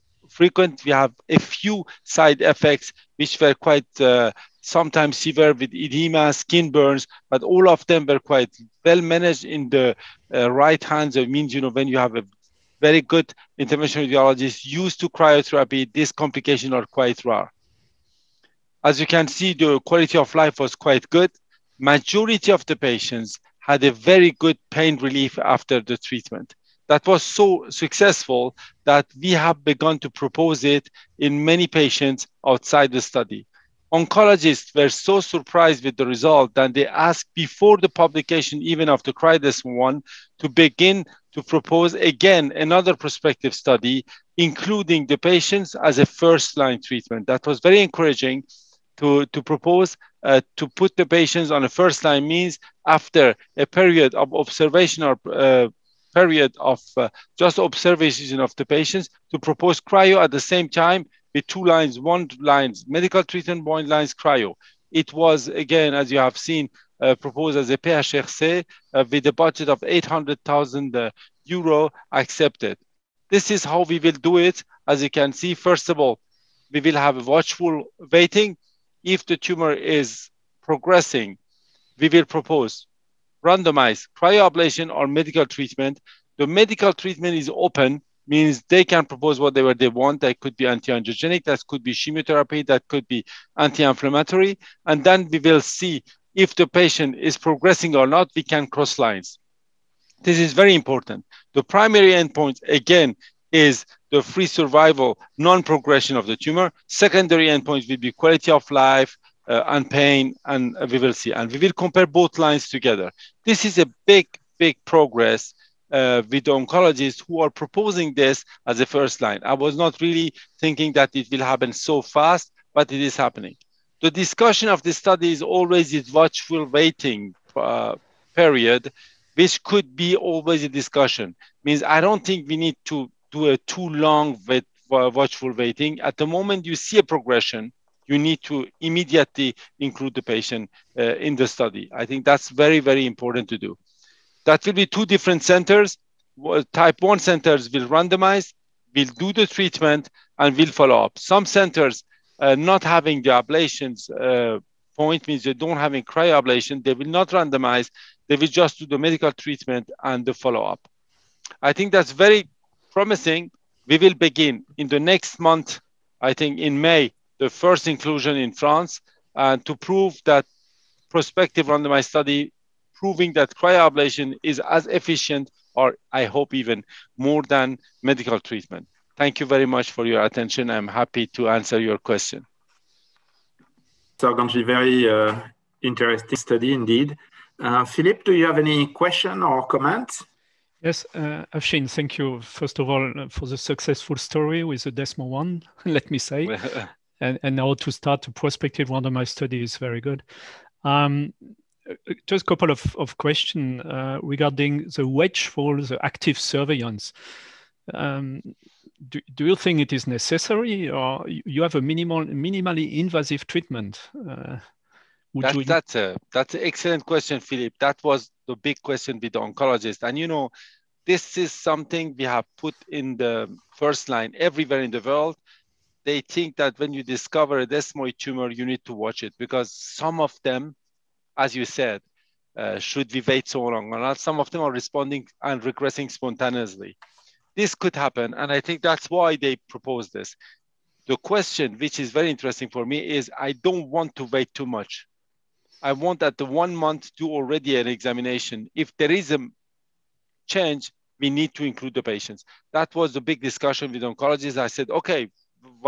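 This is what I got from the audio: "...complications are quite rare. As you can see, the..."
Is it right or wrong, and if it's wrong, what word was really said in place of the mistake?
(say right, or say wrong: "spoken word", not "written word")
right.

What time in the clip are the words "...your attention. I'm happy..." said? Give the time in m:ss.
3:00.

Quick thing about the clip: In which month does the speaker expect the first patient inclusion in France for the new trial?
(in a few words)
May.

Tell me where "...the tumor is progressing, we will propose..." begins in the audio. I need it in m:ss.
1:19.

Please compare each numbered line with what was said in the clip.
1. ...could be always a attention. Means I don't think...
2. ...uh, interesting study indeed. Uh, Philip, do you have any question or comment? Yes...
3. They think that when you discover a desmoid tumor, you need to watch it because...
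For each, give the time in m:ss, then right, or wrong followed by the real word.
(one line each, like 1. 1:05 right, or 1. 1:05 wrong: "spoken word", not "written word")
1. 2:09 wrong: "discussion", not "attention"
2. 3:05 right
3. 3:46 right.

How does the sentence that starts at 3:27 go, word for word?
Um, do, do, you think it is necessary or you have a minimal, minimally invasive treatment?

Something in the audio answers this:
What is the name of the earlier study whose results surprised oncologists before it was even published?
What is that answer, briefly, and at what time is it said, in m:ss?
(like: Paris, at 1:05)
CRIDIS, at 0:39.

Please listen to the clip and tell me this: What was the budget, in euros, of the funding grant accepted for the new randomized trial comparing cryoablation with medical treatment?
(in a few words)
800,000 euros.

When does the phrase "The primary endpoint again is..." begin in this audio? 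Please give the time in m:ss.
1:41.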